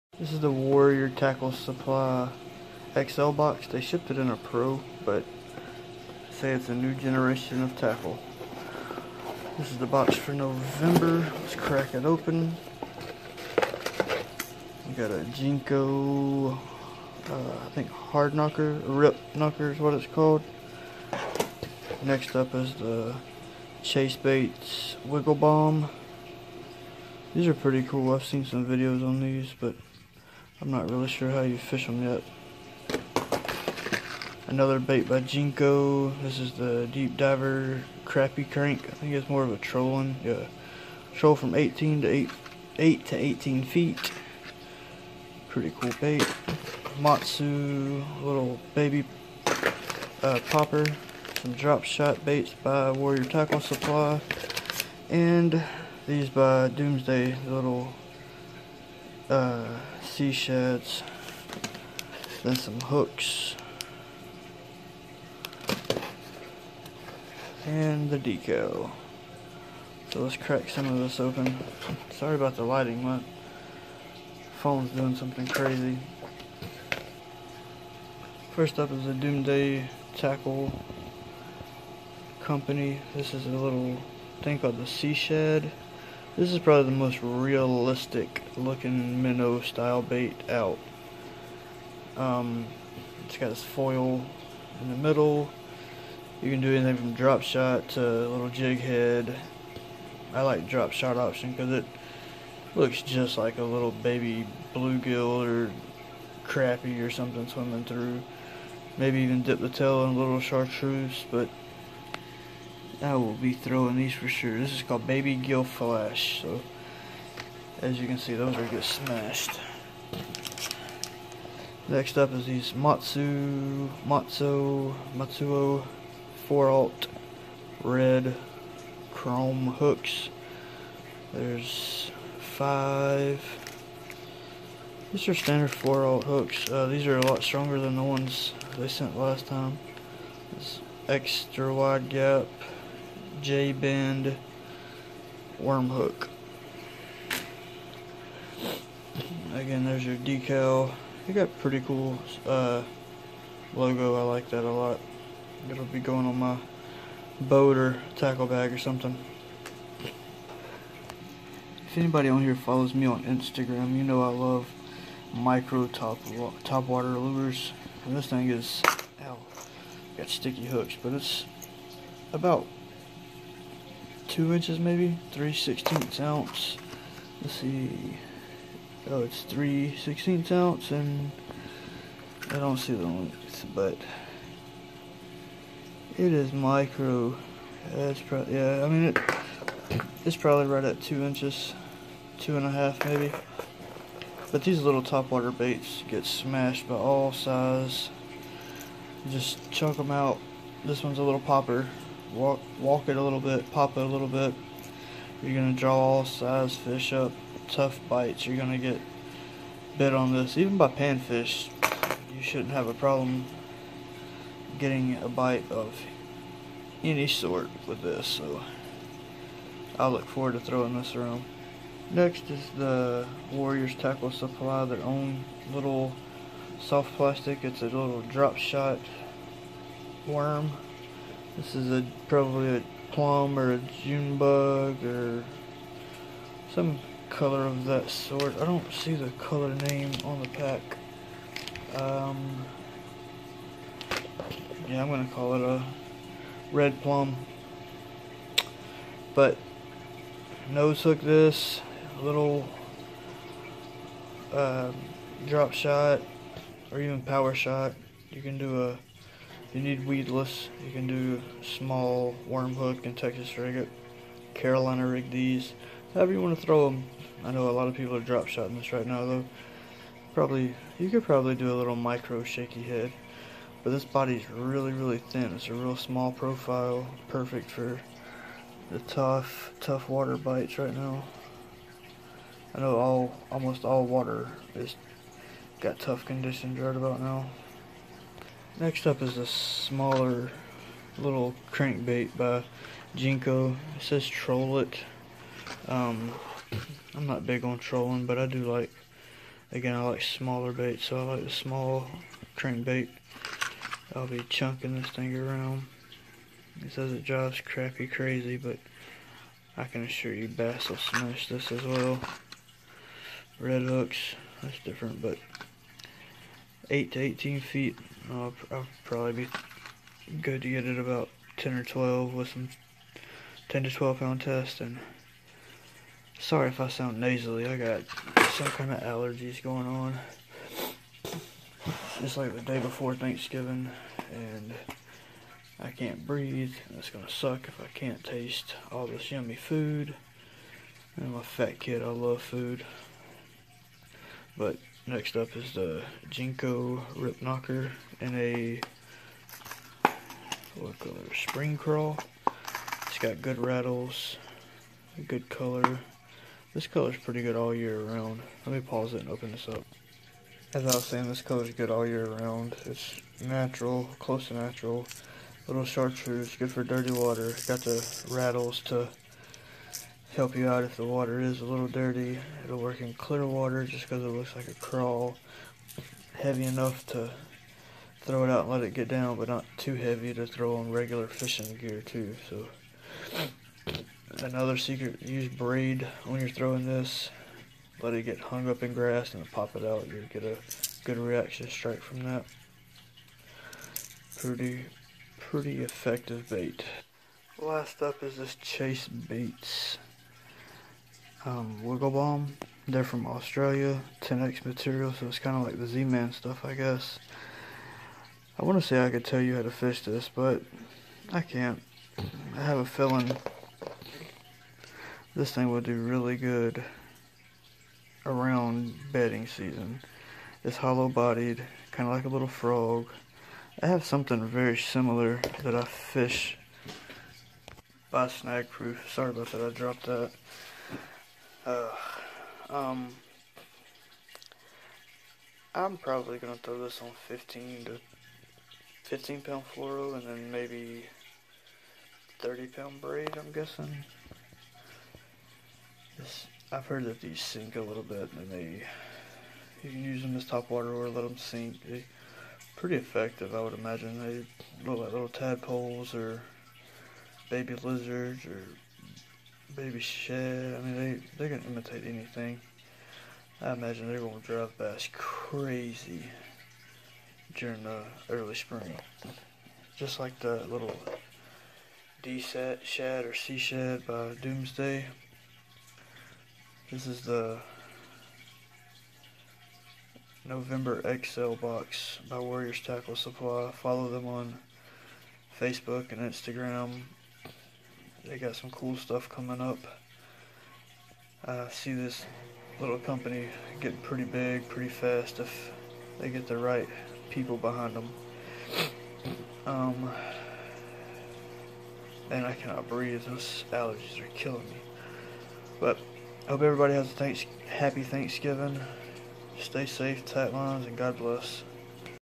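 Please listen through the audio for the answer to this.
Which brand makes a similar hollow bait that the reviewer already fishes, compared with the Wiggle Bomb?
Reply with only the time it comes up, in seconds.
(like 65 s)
428 s.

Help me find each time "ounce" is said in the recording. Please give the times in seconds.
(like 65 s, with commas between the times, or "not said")
176 s, 180 s.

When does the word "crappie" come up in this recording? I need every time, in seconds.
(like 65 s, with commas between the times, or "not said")
38 s, 106 s, 307 s.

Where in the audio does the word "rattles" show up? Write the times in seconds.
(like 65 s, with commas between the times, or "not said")
353 s, 368 s.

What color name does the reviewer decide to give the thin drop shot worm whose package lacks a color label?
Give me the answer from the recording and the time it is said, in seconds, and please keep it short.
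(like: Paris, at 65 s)
red plum, at 246 s.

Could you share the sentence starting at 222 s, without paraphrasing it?
Next is the Warriors Tackle Supply, their own little soft plastic.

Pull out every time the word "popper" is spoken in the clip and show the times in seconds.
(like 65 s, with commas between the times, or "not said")
50 s, 201 s.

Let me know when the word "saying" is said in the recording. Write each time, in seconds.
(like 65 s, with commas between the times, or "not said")
361 s.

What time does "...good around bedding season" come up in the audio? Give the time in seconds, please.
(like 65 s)
416 s.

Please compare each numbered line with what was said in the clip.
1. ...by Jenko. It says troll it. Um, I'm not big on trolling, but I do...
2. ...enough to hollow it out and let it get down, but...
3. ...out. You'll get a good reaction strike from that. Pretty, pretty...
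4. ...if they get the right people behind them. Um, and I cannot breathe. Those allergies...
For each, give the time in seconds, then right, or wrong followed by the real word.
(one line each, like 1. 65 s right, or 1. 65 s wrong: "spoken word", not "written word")
1. 292 s right
2. 376 s wrong: "throw", not "hollow"
3. 389 s right
4. 495 s right.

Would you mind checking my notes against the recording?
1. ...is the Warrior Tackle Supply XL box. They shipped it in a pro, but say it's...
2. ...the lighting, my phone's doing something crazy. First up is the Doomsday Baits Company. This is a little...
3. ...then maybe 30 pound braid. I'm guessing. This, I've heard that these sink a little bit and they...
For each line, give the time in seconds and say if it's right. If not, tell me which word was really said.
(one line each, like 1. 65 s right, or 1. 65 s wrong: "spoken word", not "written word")
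1. 0 s right
2. 72 s wrong: "Tackle", not "Baits"
3. 440 s right.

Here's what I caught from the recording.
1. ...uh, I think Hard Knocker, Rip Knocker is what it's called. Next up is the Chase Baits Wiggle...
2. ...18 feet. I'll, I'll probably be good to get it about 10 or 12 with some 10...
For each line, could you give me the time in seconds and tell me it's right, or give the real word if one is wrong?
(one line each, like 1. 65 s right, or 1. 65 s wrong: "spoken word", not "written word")
1. 16 s right
2. 317 s right.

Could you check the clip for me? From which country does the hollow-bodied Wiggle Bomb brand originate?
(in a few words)
Australia.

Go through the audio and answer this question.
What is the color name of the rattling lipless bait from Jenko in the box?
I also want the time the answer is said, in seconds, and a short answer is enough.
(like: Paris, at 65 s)
Spring Crawl, at 351 s.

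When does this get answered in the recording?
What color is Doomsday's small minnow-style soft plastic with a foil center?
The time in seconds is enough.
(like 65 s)
115 s.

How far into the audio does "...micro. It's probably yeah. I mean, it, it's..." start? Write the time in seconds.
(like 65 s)
186 s.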